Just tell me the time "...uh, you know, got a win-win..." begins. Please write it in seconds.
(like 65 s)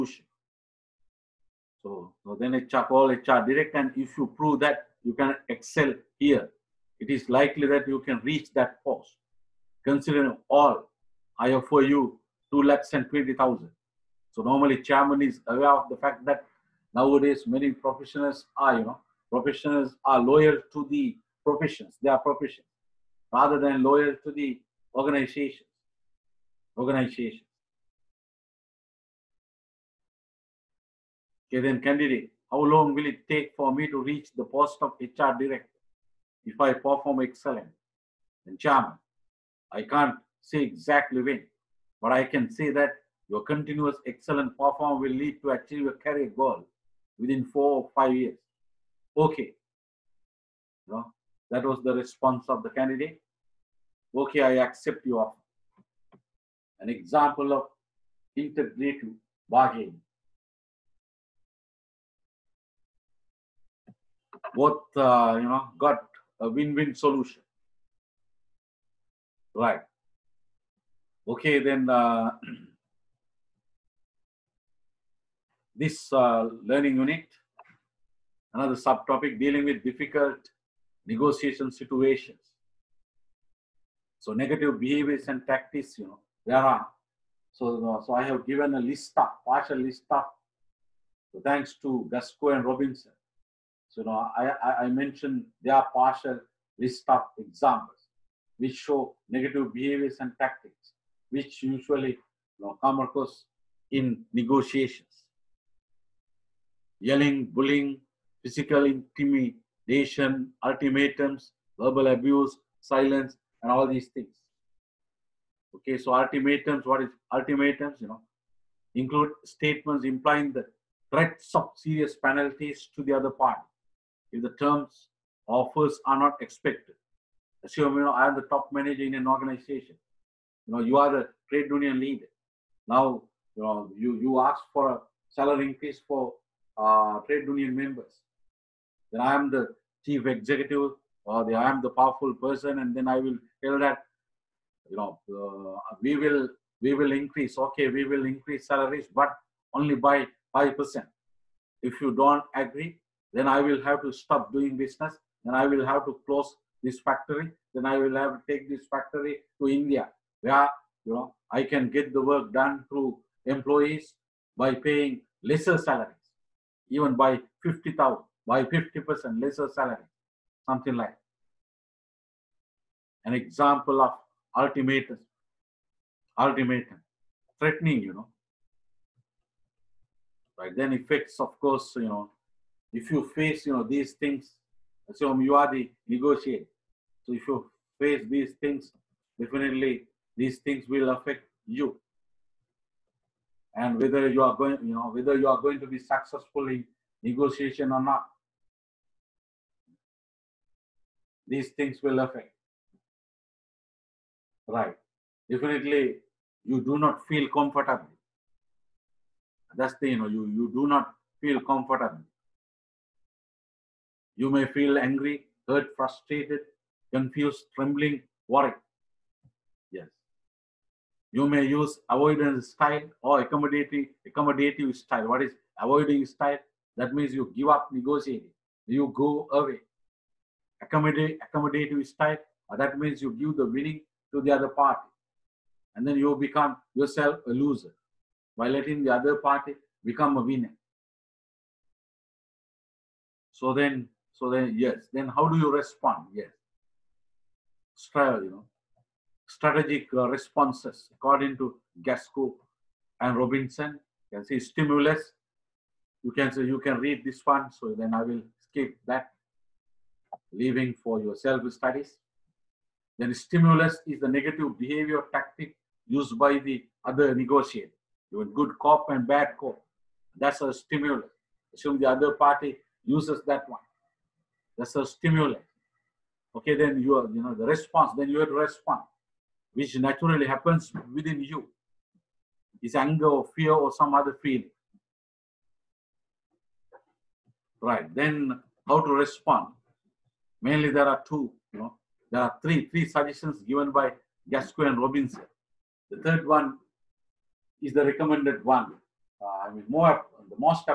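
64 s.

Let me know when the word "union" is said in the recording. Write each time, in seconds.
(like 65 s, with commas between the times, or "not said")
131 s, 137 s.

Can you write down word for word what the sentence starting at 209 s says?
That's the, you know, you, you do not feel comfortable.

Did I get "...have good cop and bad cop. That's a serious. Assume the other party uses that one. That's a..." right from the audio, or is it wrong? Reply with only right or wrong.
wrong.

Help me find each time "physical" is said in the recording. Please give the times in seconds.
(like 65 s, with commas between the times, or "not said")
108 s.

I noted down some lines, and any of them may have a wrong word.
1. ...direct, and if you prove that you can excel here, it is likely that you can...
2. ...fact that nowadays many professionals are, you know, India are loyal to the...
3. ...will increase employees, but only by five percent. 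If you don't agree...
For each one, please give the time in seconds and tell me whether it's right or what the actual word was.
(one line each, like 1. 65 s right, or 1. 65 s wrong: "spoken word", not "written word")
1. 3 s right
2. 15 s wrong: "Professionals", not "India"
3. 148 s wrong: "salaries", not "employees".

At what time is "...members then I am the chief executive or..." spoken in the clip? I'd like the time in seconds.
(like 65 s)
137 s.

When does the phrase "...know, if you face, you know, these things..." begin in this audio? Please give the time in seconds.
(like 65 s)
182 s.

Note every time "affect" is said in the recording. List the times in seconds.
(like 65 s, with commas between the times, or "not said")
191 s, 202 s.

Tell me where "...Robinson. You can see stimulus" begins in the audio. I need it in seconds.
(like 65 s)
253 s.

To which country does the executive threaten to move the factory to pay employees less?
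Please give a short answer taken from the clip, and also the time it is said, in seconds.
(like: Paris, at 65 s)
India, at 159 s.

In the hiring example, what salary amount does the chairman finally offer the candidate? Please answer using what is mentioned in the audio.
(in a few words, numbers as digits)
2 lakhs and 20,000.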